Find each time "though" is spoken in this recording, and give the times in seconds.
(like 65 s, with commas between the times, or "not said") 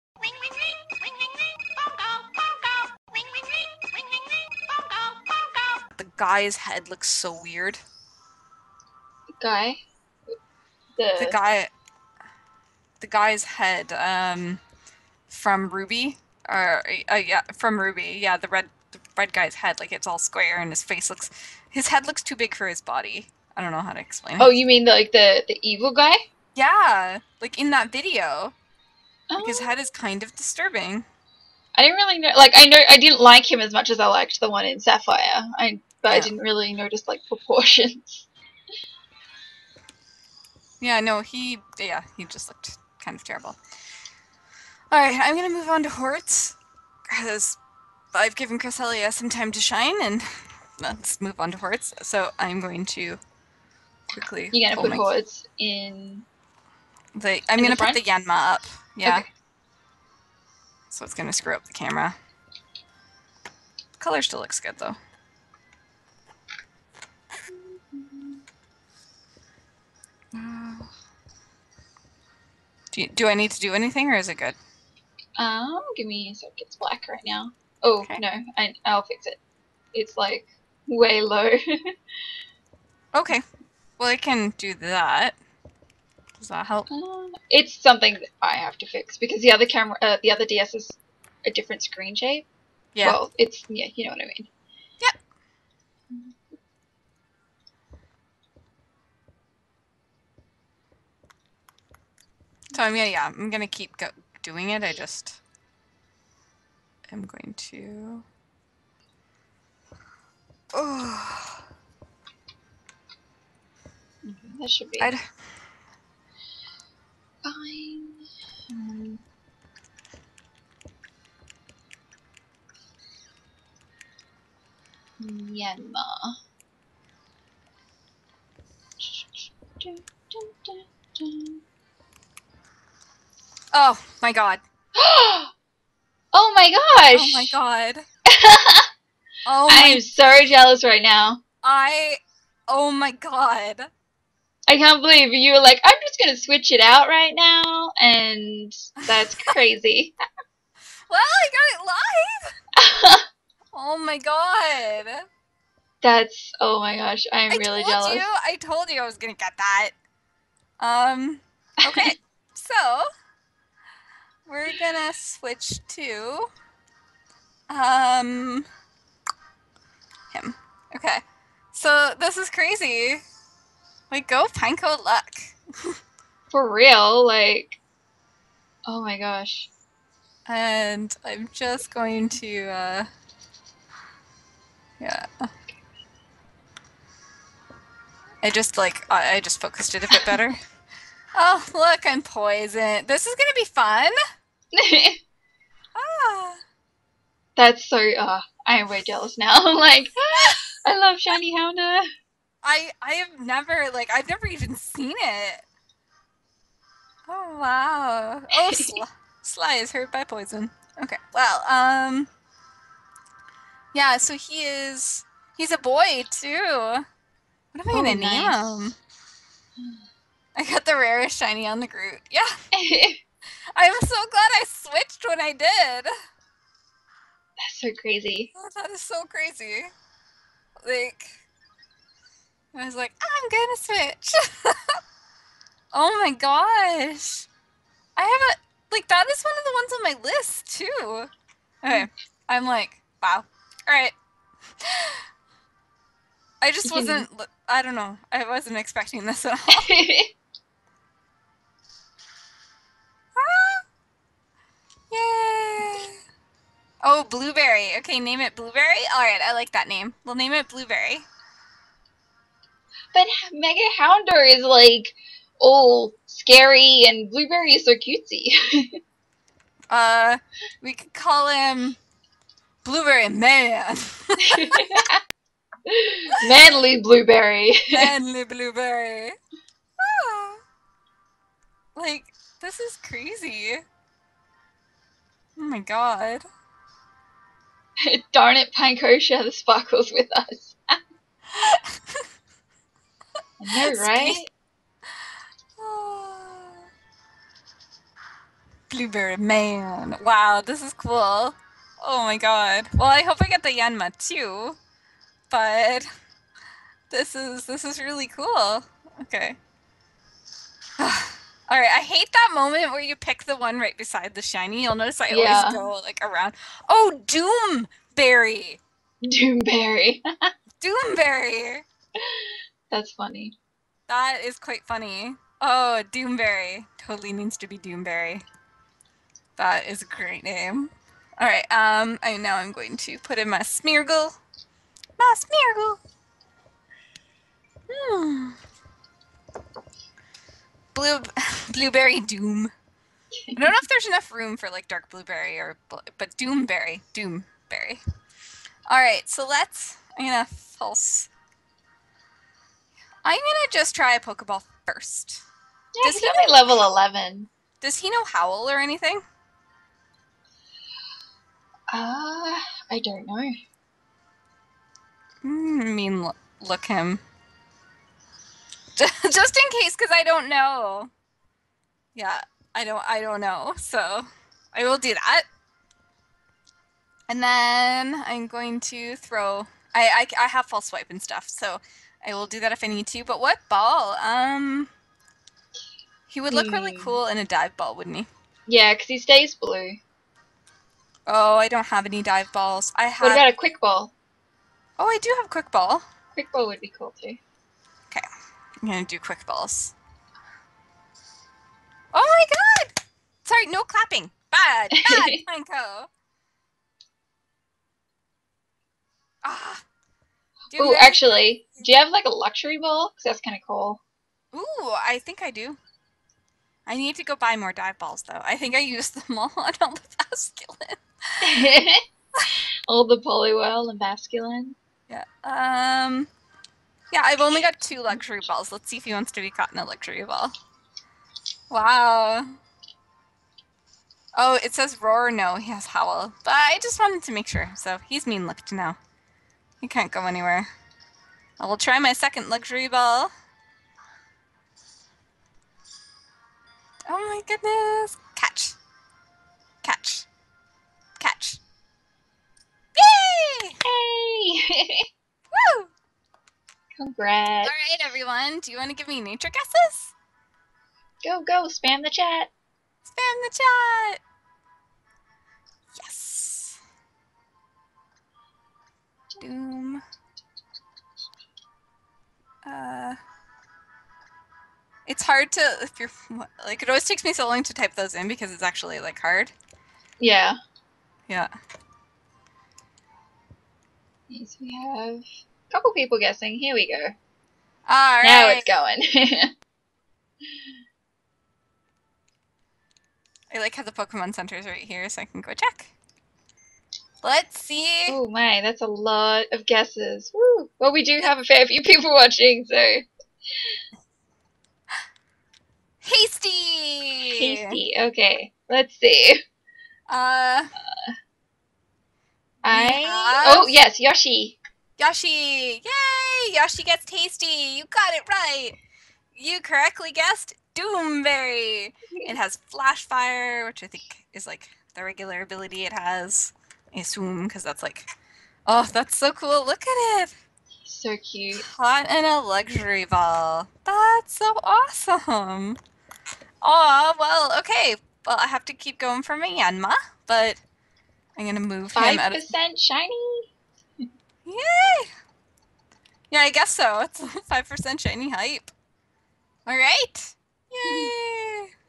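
64 s, 418 s.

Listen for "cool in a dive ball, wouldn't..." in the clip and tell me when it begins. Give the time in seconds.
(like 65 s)
387 s.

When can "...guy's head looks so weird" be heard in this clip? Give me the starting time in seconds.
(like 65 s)
6 s.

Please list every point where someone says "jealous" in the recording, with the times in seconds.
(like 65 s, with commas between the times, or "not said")
140 s, 157 s, 199 s.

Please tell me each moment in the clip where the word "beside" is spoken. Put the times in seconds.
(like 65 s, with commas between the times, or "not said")
313 s.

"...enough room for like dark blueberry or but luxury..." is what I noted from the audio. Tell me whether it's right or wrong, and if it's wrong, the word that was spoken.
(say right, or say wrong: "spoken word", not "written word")
wrong: "doomberry", not "luxury".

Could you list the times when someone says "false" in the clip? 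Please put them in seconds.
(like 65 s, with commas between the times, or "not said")
350 s, 380 s.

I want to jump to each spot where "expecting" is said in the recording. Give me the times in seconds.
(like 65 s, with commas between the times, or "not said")
248 s.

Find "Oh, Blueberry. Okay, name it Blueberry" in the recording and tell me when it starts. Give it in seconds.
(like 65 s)
257 s.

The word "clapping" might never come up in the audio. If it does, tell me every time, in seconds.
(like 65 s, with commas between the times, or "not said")
403 s.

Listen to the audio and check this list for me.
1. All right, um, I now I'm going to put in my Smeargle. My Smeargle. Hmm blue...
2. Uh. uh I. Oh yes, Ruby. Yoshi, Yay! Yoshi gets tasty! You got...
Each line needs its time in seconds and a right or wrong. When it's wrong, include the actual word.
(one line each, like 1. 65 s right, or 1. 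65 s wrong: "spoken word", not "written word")
1. 331 s right
2. 510 s wrong: "Yoshi", not "Ruby".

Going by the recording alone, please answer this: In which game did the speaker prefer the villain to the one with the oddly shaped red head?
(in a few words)
Sapphire.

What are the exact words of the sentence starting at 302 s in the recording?
Well, I hope I get the Yanma too.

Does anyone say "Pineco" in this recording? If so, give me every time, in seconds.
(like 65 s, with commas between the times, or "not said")
174 s, 288 s, 405 s.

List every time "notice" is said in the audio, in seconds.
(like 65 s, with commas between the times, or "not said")
36 s, 314 s.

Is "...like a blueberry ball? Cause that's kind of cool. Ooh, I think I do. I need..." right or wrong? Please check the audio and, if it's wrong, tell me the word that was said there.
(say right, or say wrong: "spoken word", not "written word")
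wrong: "luxury", not "blueberry".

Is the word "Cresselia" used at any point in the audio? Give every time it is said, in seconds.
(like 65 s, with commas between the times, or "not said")
48 s.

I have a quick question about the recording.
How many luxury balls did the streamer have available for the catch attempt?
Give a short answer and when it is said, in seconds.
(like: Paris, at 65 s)
2, at 427 s.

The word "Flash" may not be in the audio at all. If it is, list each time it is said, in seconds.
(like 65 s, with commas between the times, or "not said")
522 s.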